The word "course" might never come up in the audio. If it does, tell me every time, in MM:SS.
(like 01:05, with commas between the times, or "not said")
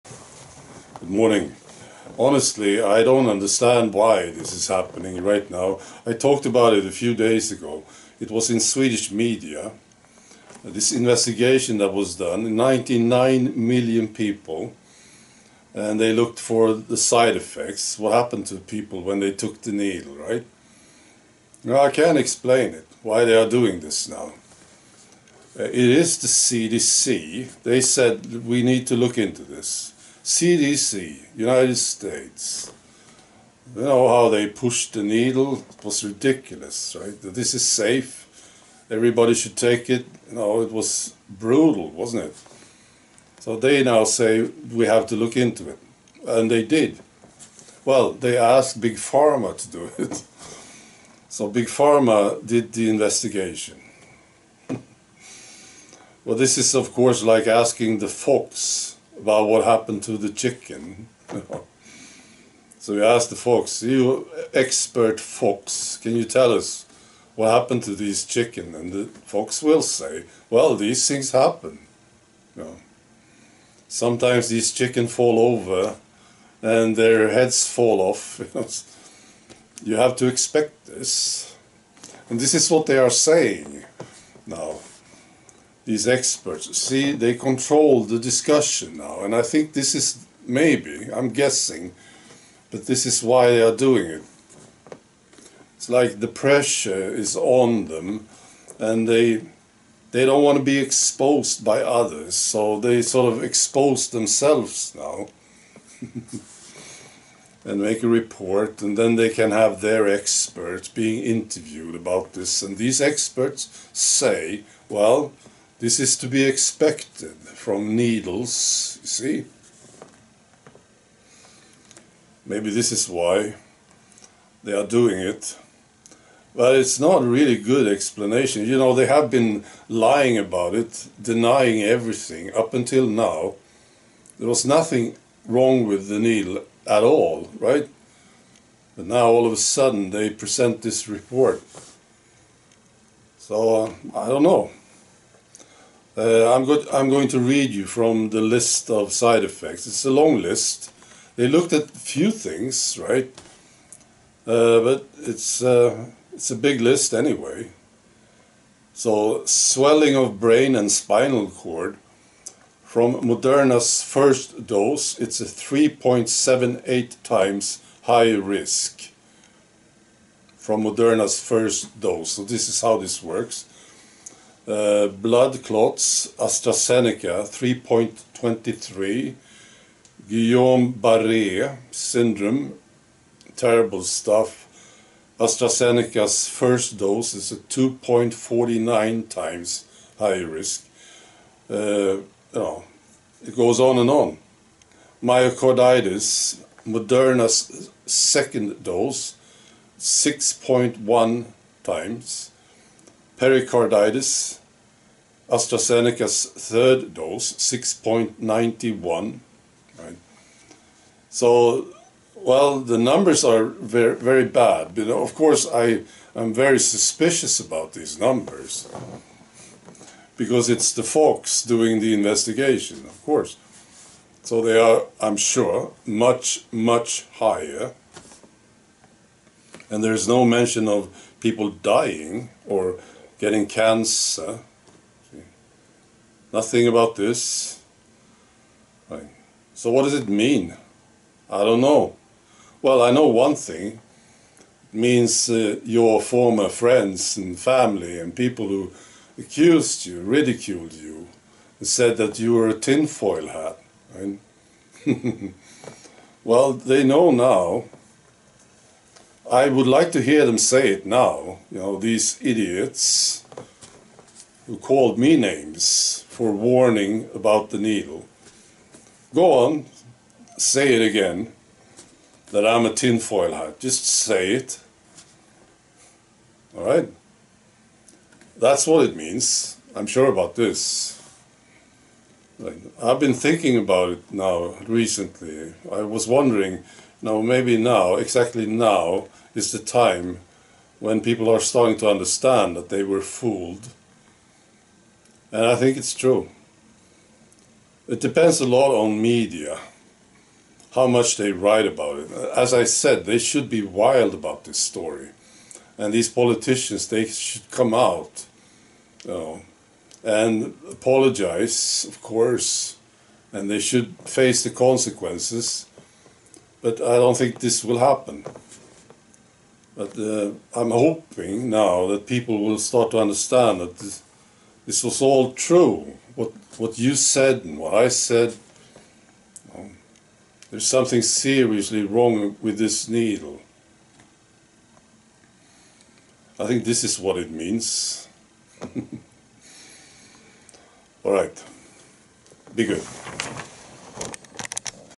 00:56, 03:35, 03:43, 05:12.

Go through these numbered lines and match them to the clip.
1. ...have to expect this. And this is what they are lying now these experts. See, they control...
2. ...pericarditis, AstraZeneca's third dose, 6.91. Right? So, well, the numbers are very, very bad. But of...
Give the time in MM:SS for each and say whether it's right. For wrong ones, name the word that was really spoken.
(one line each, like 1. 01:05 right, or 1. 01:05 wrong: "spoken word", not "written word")
1. 01:19 wrong: "saying", not "lying"
2. 03:23 right.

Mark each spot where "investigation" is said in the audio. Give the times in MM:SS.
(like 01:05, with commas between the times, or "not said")
00:10, 00:52, 03:42.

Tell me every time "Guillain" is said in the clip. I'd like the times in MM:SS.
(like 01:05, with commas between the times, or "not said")
03:00.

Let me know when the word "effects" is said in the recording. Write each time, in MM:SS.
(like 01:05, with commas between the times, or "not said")
00:17, 02:29.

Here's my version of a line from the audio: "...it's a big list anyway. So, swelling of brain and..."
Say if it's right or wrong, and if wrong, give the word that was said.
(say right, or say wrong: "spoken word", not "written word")
right.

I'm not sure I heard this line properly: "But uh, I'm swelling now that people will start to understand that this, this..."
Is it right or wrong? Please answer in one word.
wrong.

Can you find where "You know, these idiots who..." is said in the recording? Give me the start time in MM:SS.
04:21.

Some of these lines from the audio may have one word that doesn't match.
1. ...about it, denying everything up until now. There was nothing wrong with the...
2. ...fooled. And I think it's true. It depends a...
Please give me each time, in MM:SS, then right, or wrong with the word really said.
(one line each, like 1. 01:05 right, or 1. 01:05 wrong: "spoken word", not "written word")
1. 02:10 right
2. 04:53 right.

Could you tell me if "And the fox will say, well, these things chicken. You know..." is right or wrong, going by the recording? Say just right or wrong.
wrong.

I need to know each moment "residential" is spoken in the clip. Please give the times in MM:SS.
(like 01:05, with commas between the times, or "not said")
not said.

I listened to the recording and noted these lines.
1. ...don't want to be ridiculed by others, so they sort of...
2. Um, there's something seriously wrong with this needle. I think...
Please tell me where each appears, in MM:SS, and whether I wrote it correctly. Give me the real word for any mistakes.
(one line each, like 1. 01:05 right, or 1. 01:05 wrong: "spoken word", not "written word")
1. 01:40 wrong: "exposed", not "ridiculed"
2. 05:29 right.